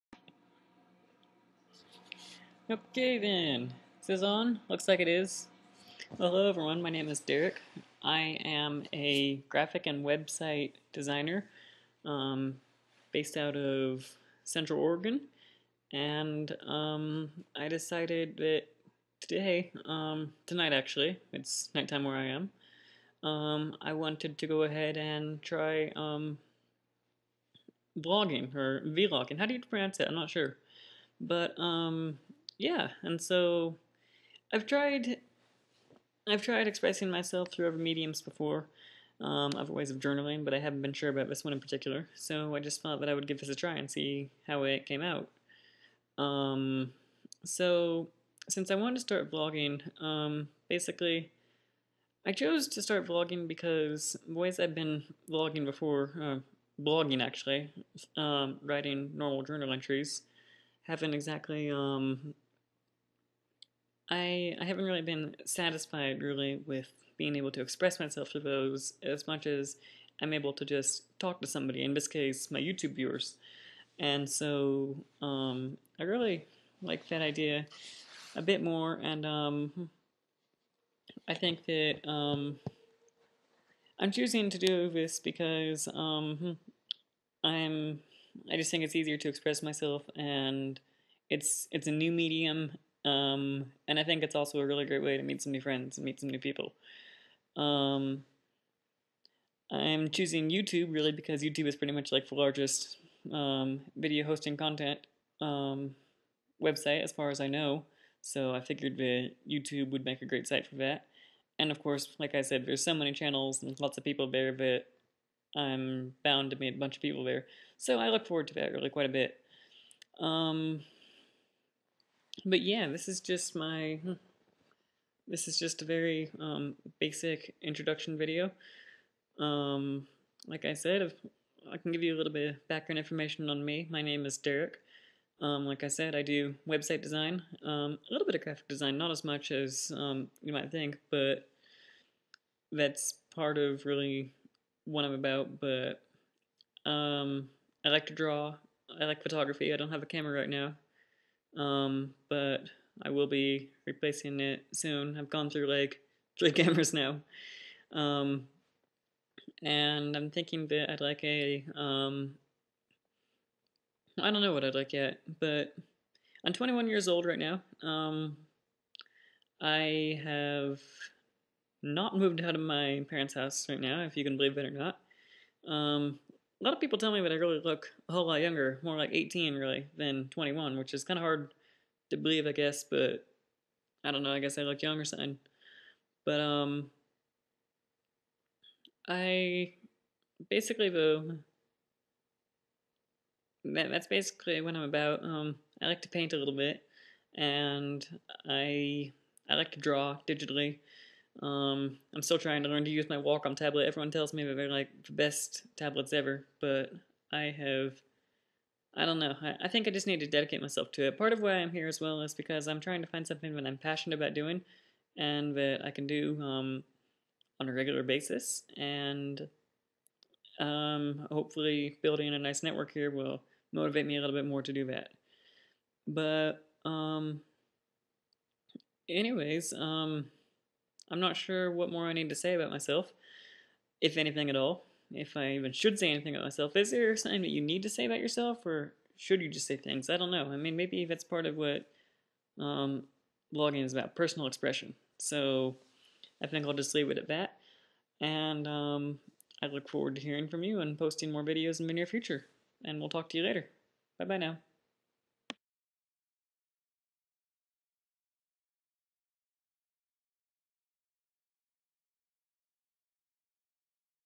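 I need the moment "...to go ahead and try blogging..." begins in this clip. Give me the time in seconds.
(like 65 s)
24 s.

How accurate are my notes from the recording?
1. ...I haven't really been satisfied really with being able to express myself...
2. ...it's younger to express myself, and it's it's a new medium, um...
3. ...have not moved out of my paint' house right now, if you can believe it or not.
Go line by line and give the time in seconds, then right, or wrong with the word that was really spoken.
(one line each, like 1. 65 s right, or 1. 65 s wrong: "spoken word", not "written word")
1. 64 s right
2. 88 s wrong: "easier", not "younger"
3. 170 s wrong: "parents", not "paint".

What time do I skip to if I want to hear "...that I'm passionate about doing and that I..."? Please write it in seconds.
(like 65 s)
213 s.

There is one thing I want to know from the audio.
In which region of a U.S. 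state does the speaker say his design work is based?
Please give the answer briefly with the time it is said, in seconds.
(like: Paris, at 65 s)
Central Oregon, at 14 s.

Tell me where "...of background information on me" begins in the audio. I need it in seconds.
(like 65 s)
132 s.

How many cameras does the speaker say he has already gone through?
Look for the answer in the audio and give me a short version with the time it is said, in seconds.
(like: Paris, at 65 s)
3, at 156 s.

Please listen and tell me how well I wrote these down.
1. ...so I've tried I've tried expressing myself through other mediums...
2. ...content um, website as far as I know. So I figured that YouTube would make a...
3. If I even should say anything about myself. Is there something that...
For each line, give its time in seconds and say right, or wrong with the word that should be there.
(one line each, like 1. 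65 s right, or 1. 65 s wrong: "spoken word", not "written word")
1. 33 s right
2. 104 s right
3. 235 s right.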